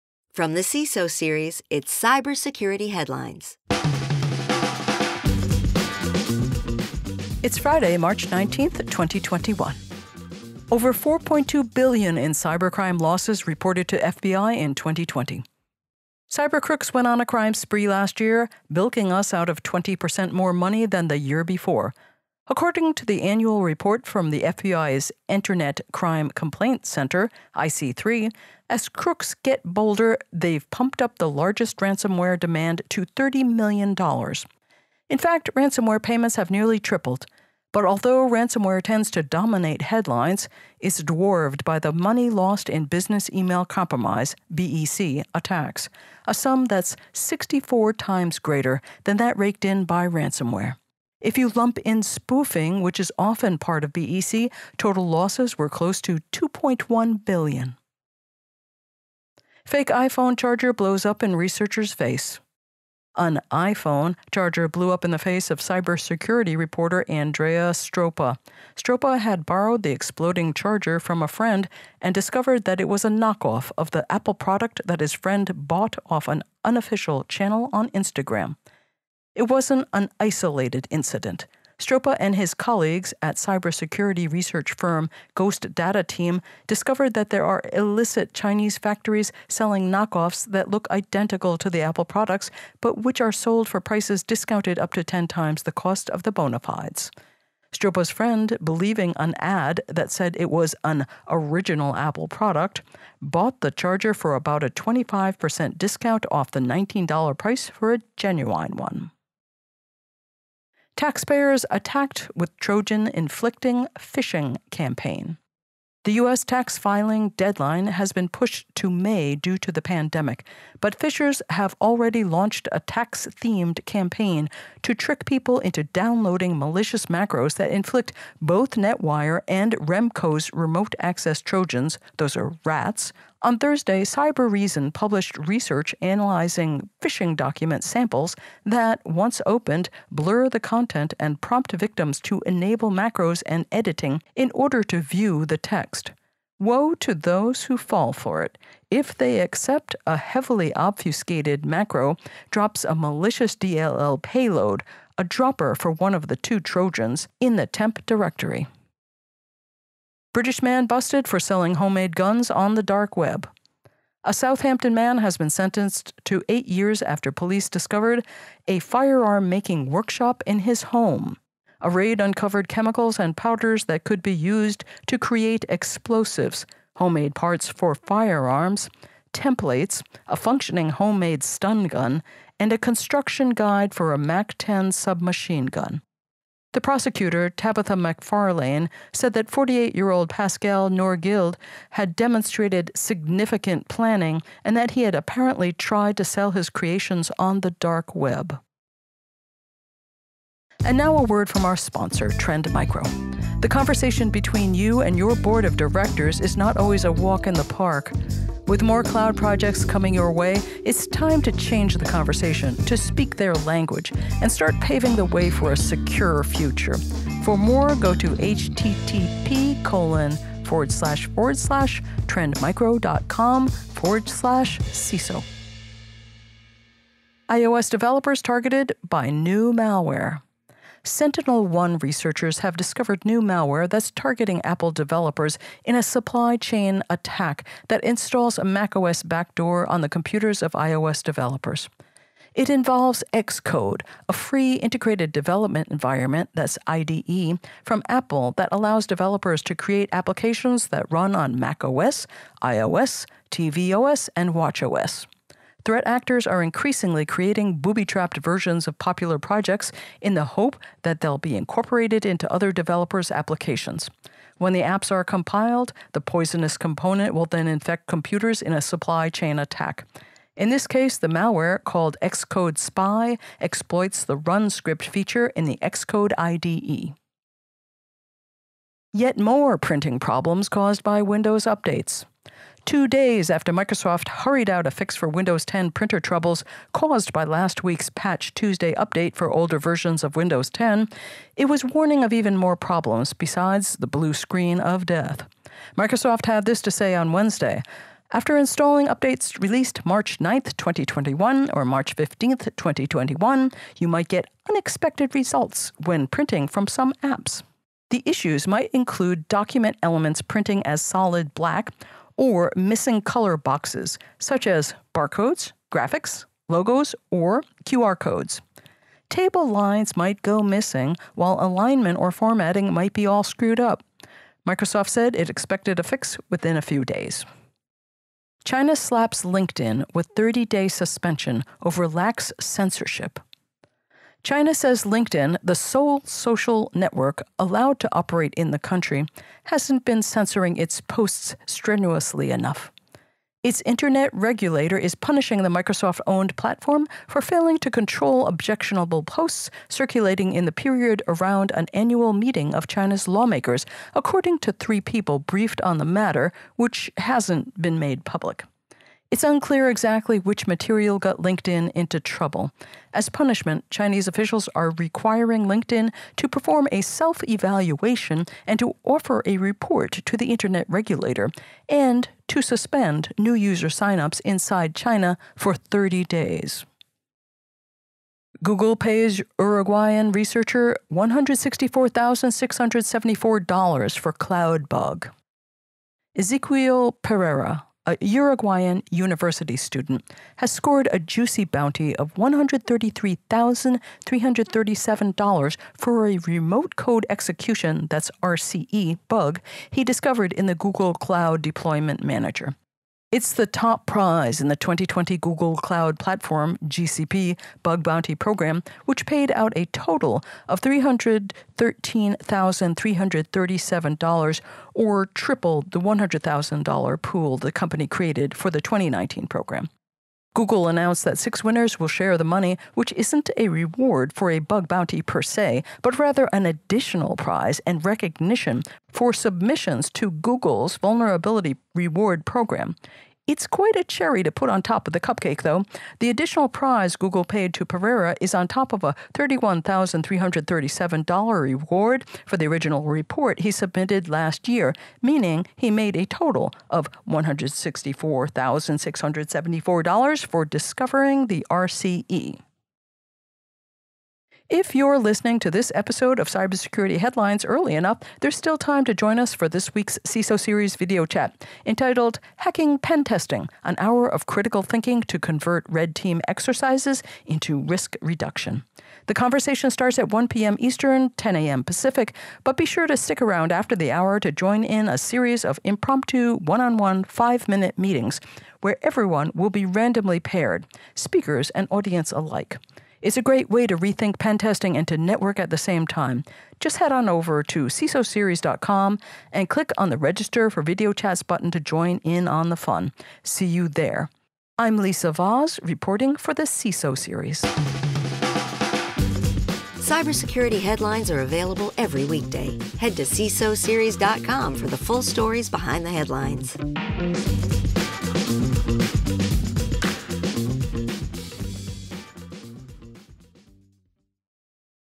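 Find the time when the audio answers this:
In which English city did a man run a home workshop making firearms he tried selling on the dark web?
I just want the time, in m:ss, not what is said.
2:44.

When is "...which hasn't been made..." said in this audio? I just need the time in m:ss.
5:56.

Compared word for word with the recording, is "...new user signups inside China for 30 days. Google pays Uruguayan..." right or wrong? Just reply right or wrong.
right.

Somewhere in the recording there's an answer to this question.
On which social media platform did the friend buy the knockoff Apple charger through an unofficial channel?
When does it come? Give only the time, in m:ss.
1:17.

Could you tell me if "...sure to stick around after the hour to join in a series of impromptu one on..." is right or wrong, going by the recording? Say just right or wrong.
right.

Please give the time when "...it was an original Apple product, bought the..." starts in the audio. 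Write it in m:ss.
1:40.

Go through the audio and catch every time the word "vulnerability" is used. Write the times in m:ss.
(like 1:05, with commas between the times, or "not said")
7:10.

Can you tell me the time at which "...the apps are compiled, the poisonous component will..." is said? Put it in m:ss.
4:24.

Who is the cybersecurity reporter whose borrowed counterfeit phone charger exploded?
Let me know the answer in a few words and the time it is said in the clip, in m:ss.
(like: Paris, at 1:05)
Andrea Stroppa, at 1:07.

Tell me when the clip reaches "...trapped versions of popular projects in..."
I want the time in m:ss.
4:18.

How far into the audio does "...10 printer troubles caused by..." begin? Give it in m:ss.
4:45.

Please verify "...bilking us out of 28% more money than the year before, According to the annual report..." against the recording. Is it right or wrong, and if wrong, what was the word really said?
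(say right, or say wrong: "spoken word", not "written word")
wrong: "20", not "28".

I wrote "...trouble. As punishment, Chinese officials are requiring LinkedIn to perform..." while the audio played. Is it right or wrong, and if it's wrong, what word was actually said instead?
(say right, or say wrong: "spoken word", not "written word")
right.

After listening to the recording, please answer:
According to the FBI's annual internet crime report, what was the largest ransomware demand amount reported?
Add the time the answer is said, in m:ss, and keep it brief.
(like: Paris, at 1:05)
$30 million, at 0:33.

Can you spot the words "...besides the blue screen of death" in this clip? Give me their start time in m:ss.
4:53.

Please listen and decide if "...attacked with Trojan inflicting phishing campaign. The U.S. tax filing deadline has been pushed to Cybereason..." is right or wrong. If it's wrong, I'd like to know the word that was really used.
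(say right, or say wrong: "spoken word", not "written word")
wrong: "May", not "Cybereason".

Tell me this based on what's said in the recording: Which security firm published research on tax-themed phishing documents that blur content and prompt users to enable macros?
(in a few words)
Cybereason.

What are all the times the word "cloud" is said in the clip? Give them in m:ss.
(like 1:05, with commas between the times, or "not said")
3:29, 6:24, 6:41, 6:45.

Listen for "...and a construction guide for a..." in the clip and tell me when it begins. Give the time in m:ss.
3:02.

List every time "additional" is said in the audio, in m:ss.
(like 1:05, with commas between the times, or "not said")
7:06, 7:16.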